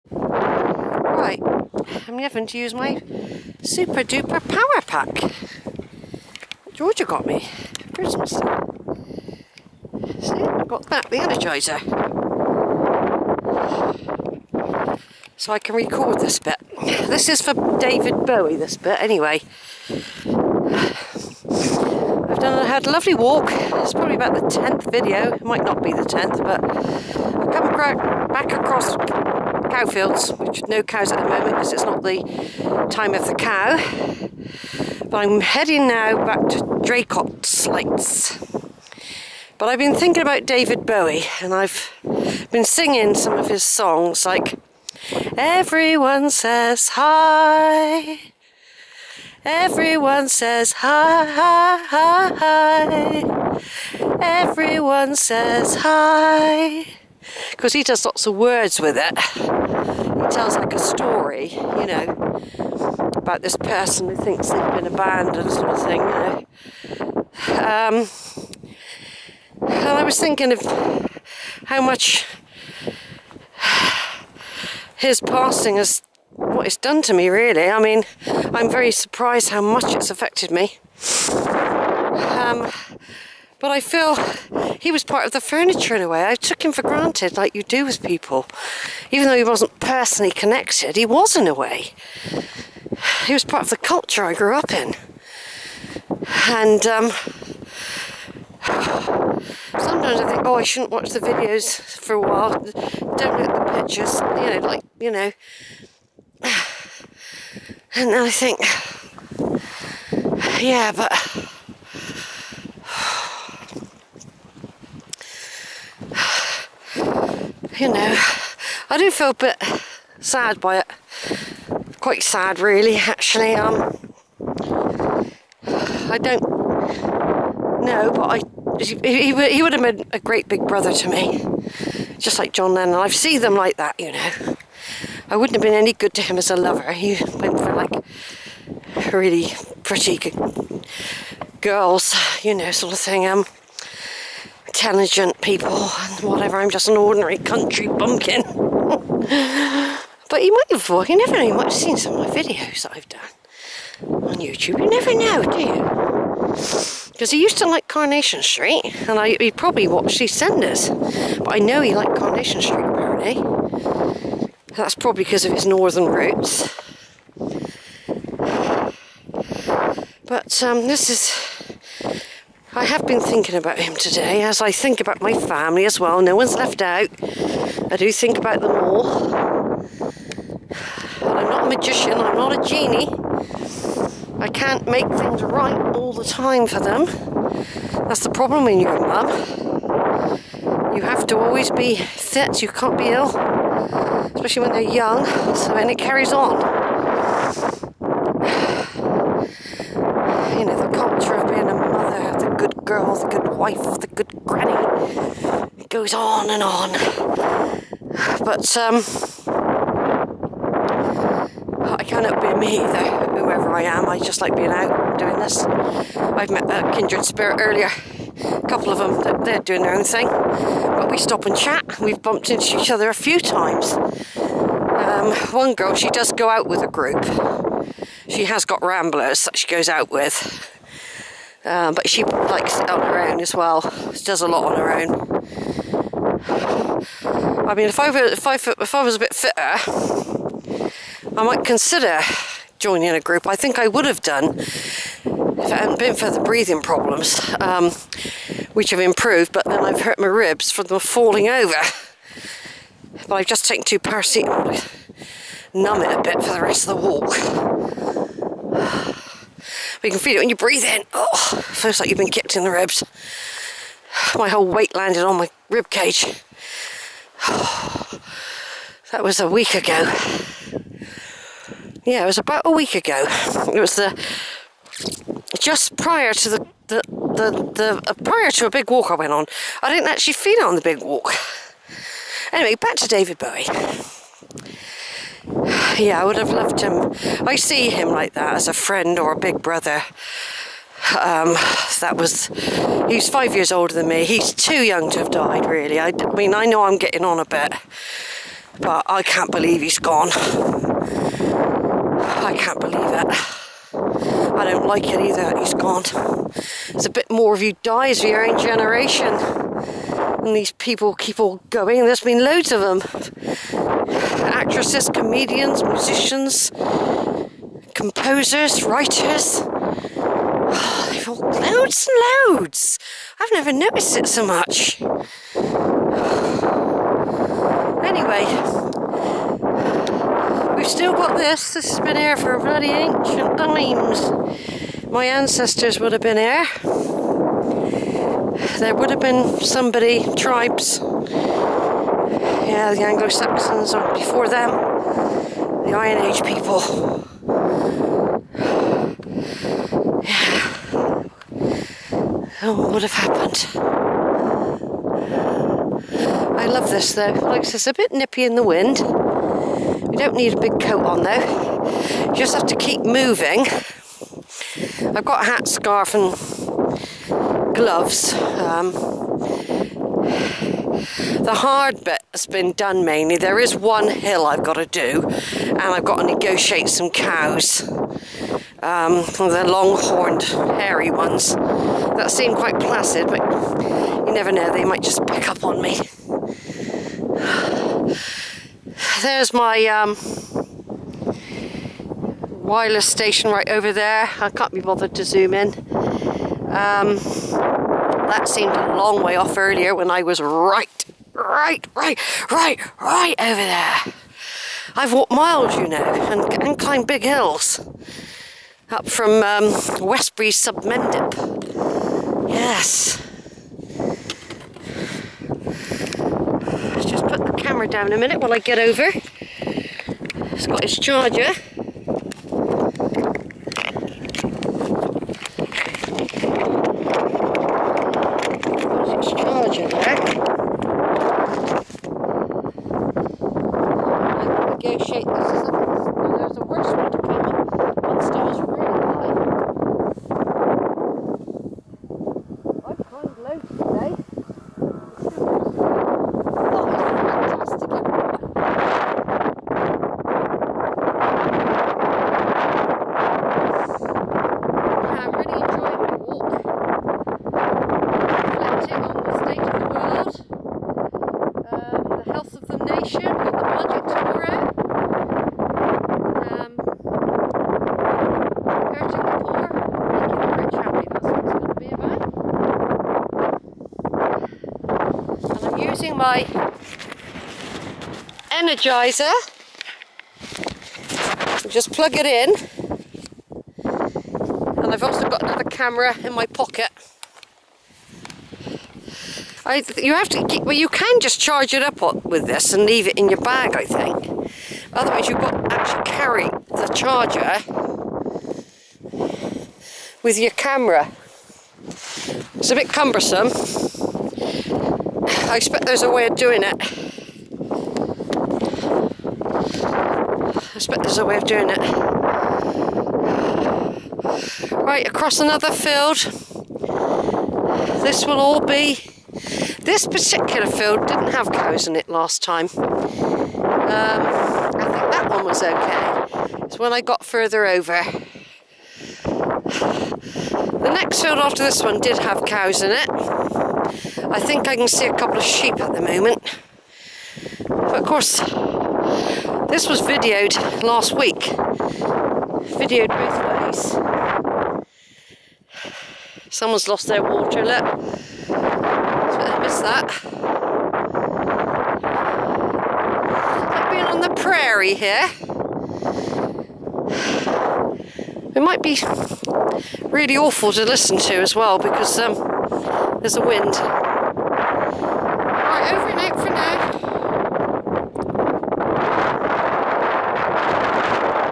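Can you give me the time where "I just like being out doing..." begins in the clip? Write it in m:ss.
3:34.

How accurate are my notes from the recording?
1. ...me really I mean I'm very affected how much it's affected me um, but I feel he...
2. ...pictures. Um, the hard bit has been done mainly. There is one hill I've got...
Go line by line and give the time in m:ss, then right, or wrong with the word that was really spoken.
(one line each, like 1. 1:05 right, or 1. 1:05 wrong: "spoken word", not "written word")
1. 1:17 wrong: "surprised", not "affected"
2. 6:07 wrong: "gloves", not "pictures".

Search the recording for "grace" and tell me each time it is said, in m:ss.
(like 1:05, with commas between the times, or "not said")
not said.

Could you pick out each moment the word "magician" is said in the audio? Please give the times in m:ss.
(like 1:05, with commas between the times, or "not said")
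3:01.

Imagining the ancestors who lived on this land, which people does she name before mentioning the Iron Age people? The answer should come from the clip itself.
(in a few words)
Anglo Saxons.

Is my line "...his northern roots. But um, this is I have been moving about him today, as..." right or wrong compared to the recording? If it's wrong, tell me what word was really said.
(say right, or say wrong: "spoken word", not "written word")
wrong: "thinking", not "moving".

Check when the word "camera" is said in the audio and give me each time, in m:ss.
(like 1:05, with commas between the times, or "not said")
6:57, 8:05, 8:20.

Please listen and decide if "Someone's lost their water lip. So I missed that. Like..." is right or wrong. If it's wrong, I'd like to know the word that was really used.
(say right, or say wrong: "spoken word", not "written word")
right.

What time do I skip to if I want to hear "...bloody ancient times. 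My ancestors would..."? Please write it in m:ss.
5:32.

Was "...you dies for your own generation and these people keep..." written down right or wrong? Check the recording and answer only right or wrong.
right.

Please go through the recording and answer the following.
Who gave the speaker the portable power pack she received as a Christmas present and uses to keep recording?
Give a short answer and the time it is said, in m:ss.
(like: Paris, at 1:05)
Georgia, at 0:06.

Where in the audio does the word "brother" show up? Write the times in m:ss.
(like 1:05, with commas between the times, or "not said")
2:10, 4:49.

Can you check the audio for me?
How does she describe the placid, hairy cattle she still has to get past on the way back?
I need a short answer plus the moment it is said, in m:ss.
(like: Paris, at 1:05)
Long-horned, at 6:19.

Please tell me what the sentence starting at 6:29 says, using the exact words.
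There's my um, wireless station right over there.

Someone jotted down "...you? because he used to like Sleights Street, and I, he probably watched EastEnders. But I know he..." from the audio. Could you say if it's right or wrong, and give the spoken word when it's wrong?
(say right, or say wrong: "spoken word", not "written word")
wrong: "Coronation", not "Sleights".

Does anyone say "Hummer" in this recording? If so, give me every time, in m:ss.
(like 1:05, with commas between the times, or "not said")
not said.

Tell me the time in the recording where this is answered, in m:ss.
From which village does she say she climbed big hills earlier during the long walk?
6:49.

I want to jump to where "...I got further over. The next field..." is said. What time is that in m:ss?
8:46.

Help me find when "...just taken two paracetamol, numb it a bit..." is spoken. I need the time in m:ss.
4:13.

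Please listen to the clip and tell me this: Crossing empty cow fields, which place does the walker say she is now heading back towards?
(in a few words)
Draycott Sleights.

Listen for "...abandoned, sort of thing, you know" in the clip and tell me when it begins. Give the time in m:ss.
1:04.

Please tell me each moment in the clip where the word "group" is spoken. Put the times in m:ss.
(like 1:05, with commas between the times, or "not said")
3:46, 4:03.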